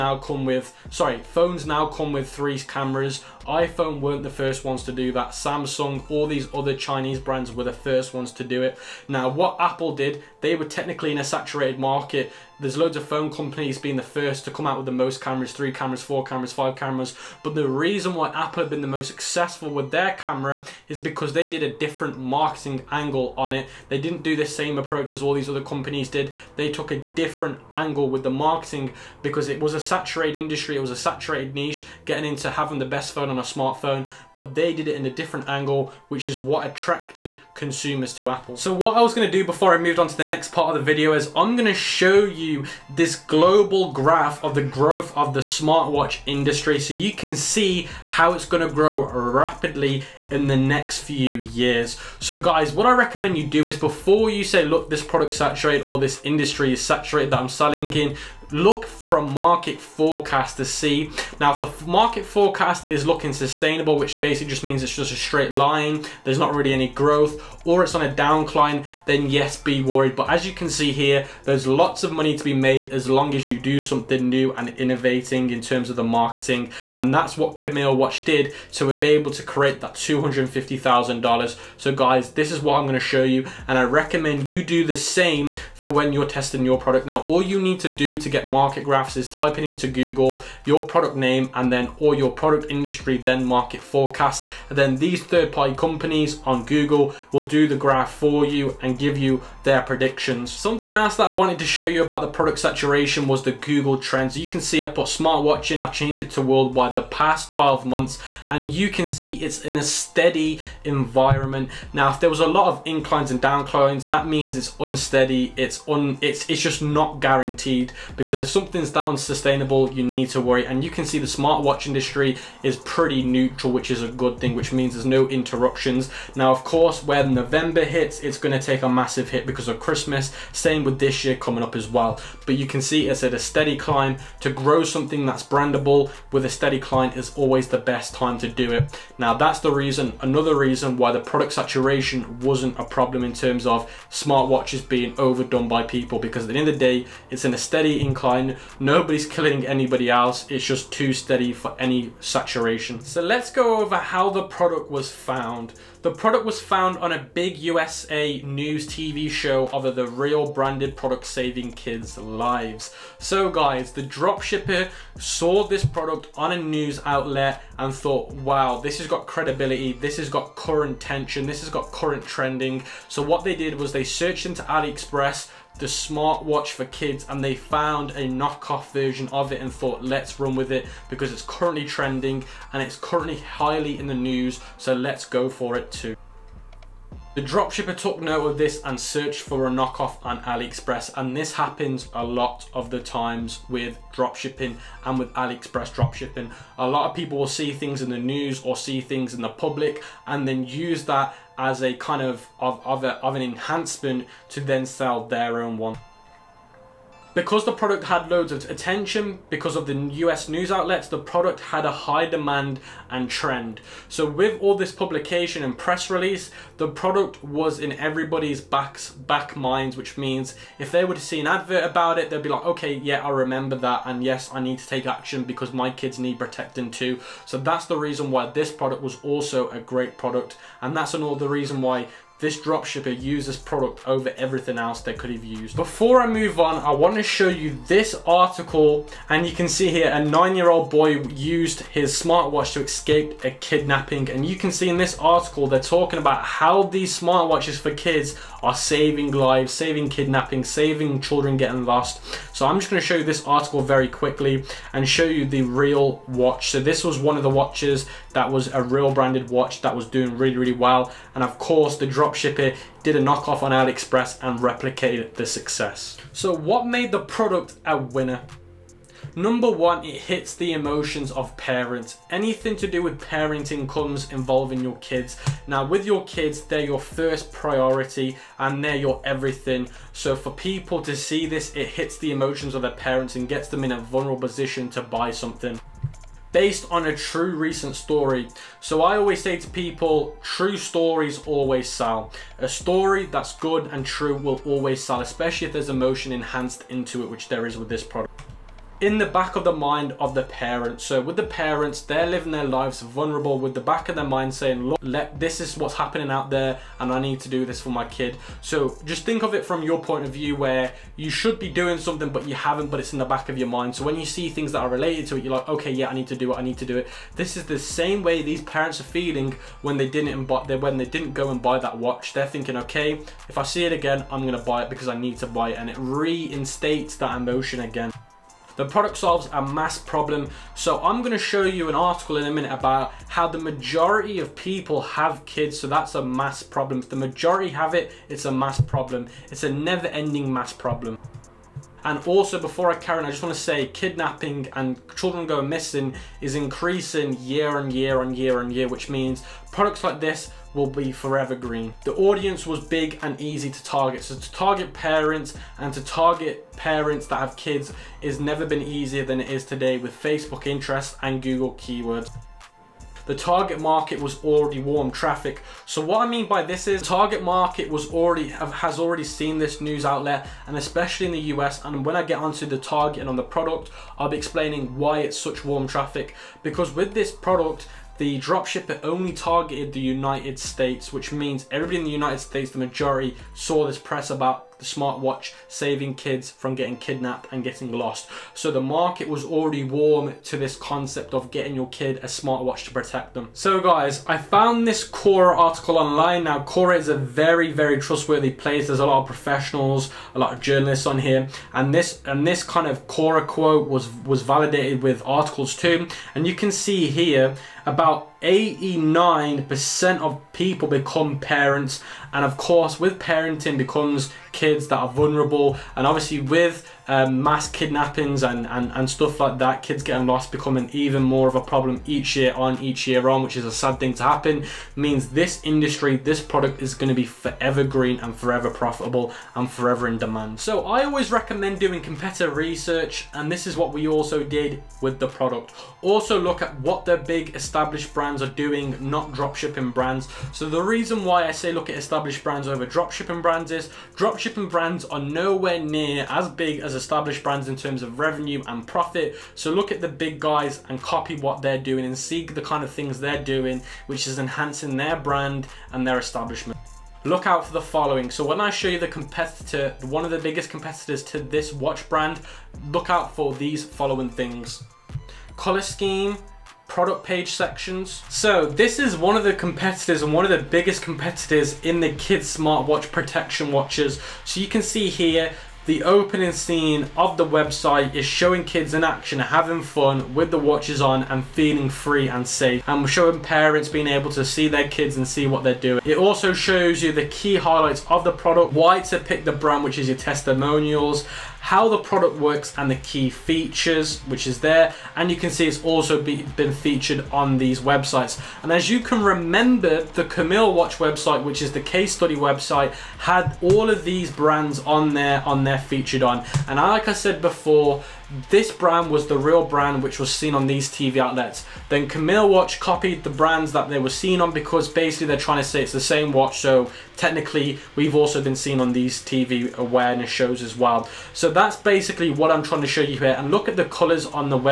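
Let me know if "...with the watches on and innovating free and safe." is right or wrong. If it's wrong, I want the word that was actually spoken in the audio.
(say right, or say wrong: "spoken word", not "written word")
wrong: "feeling", not "innovating".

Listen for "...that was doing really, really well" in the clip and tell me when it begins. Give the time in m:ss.
4:19.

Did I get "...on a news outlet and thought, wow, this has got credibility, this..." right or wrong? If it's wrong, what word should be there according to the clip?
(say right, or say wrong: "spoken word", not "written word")
right.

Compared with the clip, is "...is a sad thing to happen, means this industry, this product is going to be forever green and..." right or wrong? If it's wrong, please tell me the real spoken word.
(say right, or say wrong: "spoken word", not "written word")
right.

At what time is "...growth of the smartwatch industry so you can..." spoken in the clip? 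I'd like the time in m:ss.
0:44.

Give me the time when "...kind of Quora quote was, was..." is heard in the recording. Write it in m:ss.
6:42.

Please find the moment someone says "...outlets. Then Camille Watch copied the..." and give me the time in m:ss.
8:31.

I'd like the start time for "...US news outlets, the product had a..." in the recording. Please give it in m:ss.
3:29.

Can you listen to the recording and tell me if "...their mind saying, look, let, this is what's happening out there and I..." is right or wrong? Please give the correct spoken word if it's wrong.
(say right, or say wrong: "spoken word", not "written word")
right.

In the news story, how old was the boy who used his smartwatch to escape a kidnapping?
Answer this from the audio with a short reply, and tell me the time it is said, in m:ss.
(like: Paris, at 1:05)
9, at 4:00.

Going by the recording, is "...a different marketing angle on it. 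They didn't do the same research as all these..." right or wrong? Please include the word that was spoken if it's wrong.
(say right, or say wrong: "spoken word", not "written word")
wrong: "approach", not "research".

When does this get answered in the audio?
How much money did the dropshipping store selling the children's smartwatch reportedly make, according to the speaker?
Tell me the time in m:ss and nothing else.
1:19.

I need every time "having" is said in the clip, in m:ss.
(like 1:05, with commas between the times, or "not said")
0:32, 7:59.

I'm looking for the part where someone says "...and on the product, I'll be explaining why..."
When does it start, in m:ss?
6:13.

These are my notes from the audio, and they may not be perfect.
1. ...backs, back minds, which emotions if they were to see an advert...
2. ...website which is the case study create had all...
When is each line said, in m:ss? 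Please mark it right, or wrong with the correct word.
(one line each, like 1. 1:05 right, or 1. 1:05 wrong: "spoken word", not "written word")
1. 3:38 wrong: "means", not "emotions"
2. 8:20 wrong: "website", not "create".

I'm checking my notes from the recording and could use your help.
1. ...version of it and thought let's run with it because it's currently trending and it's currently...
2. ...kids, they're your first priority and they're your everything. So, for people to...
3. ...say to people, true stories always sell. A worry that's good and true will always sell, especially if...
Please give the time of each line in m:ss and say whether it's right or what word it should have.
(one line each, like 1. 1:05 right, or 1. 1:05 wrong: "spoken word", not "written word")
1. 2:58 right
2. 4:36 right
3. 4:49 wrong: "story", not "worry".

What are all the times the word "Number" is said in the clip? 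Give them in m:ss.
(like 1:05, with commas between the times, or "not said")
4:29.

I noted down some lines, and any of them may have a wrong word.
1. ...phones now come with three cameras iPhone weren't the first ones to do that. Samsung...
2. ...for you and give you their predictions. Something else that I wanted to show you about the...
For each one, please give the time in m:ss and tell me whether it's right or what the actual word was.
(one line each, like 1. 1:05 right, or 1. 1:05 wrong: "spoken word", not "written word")
1. 0:01 right
2. 1:38 right.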